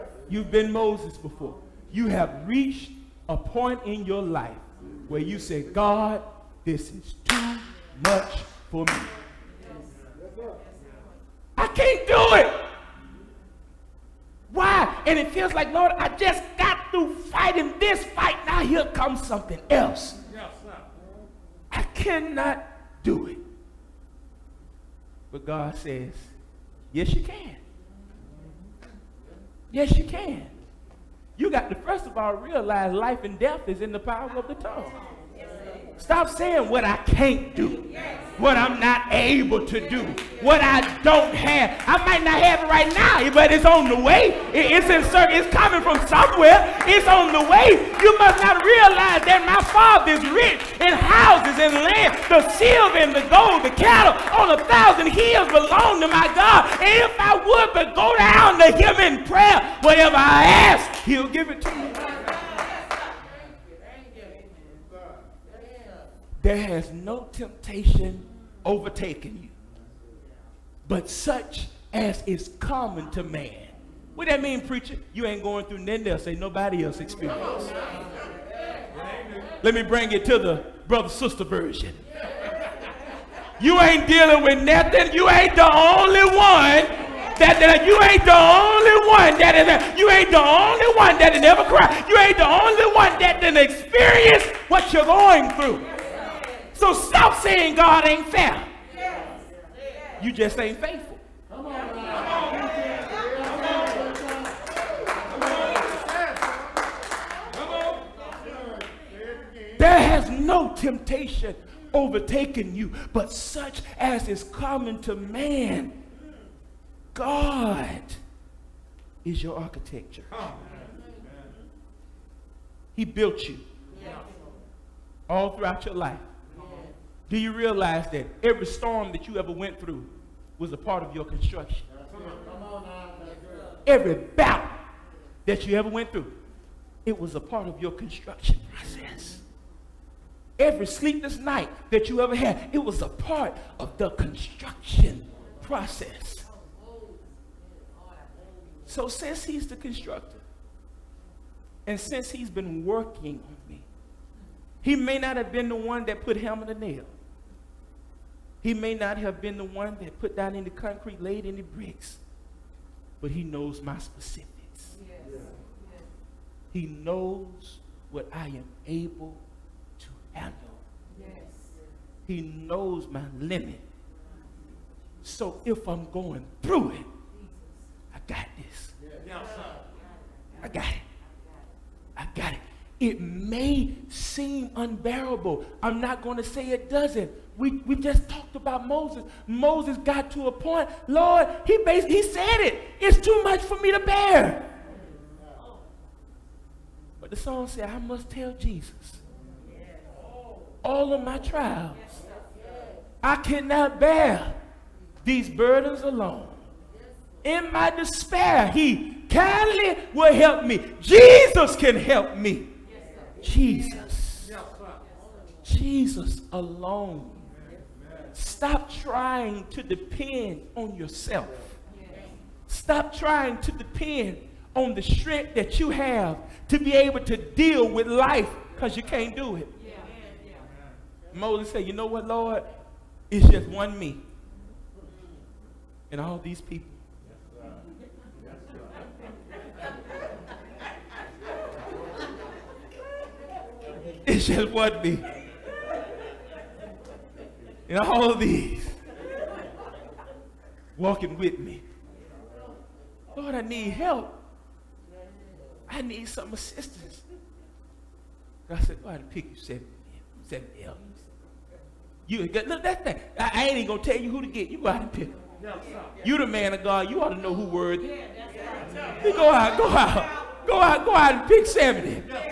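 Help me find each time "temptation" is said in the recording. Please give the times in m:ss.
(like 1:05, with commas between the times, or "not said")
1:07, 1:50.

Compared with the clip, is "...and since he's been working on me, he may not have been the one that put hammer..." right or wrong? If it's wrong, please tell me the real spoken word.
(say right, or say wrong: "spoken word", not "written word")
right.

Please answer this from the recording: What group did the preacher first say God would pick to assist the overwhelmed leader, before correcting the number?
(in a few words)
Seven elders.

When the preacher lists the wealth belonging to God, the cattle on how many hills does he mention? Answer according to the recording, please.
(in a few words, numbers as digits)
1000.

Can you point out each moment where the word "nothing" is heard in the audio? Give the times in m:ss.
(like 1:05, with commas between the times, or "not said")
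1:15, 1:24.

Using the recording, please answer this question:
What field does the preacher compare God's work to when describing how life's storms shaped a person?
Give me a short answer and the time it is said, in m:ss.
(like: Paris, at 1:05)
Architecture, at 1:59.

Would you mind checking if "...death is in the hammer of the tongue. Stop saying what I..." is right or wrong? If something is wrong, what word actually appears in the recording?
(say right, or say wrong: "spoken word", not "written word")
wrong: "power", not "hammer".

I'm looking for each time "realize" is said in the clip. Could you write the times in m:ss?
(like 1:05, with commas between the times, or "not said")
0:32, 0:48, 2:07.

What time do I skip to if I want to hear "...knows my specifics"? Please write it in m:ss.
2:43.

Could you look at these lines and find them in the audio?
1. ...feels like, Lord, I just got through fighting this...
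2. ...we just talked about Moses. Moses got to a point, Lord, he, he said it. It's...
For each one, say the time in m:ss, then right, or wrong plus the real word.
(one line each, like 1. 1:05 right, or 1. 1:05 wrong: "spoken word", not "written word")
1. 0:15 right
2. 3:07 right.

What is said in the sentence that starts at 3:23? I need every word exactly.
I cannot bear these burdens alone.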